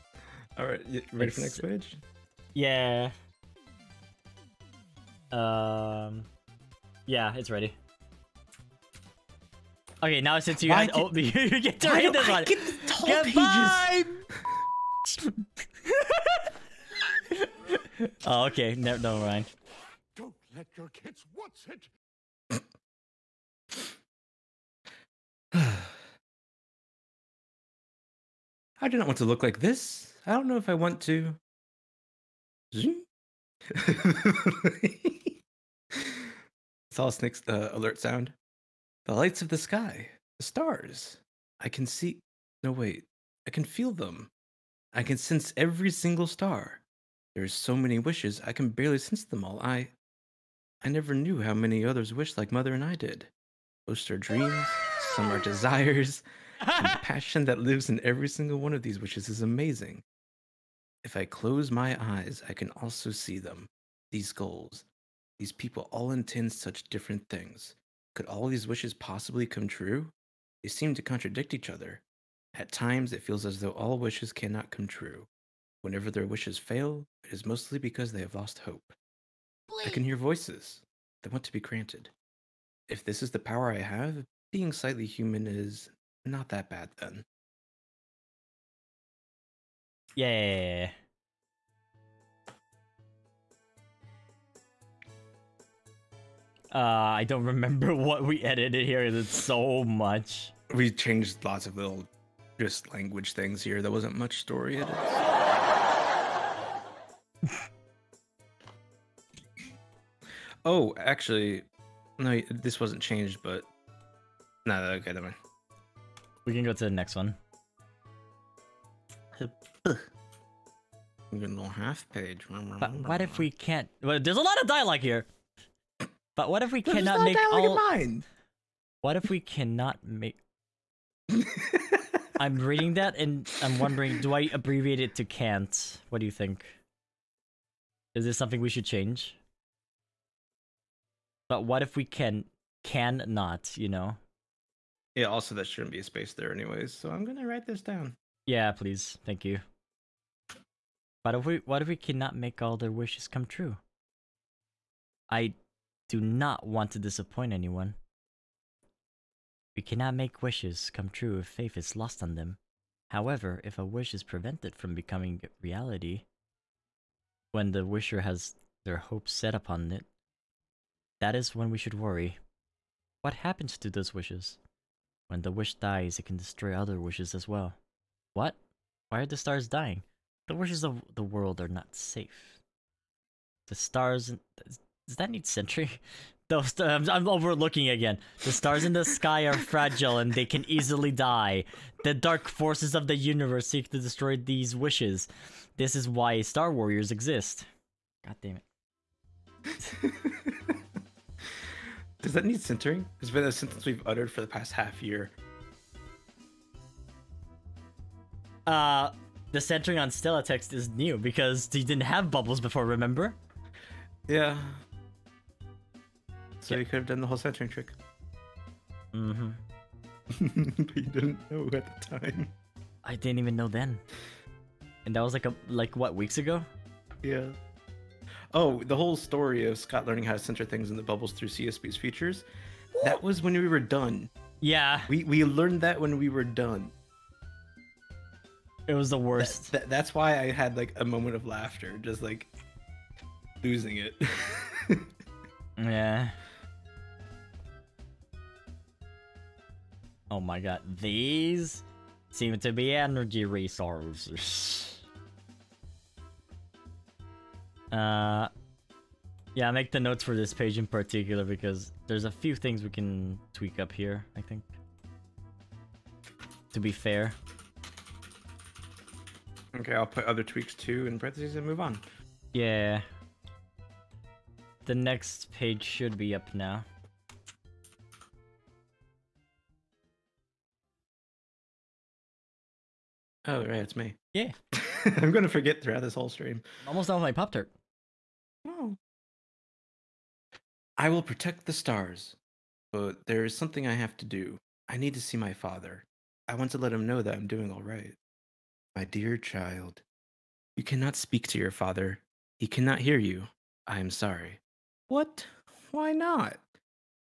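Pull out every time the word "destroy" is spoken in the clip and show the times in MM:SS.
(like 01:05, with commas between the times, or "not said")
02:56, 03:13.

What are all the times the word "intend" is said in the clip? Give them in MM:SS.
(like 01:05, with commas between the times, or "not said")
01:06.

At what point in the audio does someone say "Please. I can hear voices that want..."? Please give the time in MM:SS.
01:19.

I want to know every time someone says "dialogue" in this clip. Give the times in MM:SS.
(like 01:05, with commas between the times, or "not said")
02:04.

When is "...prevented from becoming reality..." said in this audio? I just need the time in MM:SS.
02:44.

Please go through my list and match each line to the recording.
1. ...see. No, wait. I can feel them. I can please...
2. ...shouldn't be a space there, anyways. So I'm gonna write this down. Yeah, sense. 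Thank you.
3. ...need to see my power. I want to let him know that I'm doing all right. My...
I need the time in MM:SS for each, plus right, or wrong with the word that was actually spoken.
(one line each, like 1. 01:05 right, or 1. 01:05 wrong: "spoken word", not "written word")
1. 00:41 wrong: "sense", not "please"
2. 02:25 wrong: "please", not "sense"
3. 04:54 wrong: "father", not "power".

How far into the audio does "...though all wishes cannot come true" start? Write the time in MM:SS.
01:13.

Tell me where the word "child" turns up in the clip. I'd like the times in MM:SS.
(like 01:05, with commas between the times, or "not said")
04:59.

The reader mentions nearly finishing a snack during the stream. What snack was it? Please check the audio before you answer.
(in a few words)
Pop Tart.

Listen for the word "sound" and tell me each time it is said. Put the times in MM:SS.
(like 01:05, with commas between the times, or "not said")
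00:37.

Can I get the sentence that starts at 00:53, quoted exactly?
Most are dreams, some are desires.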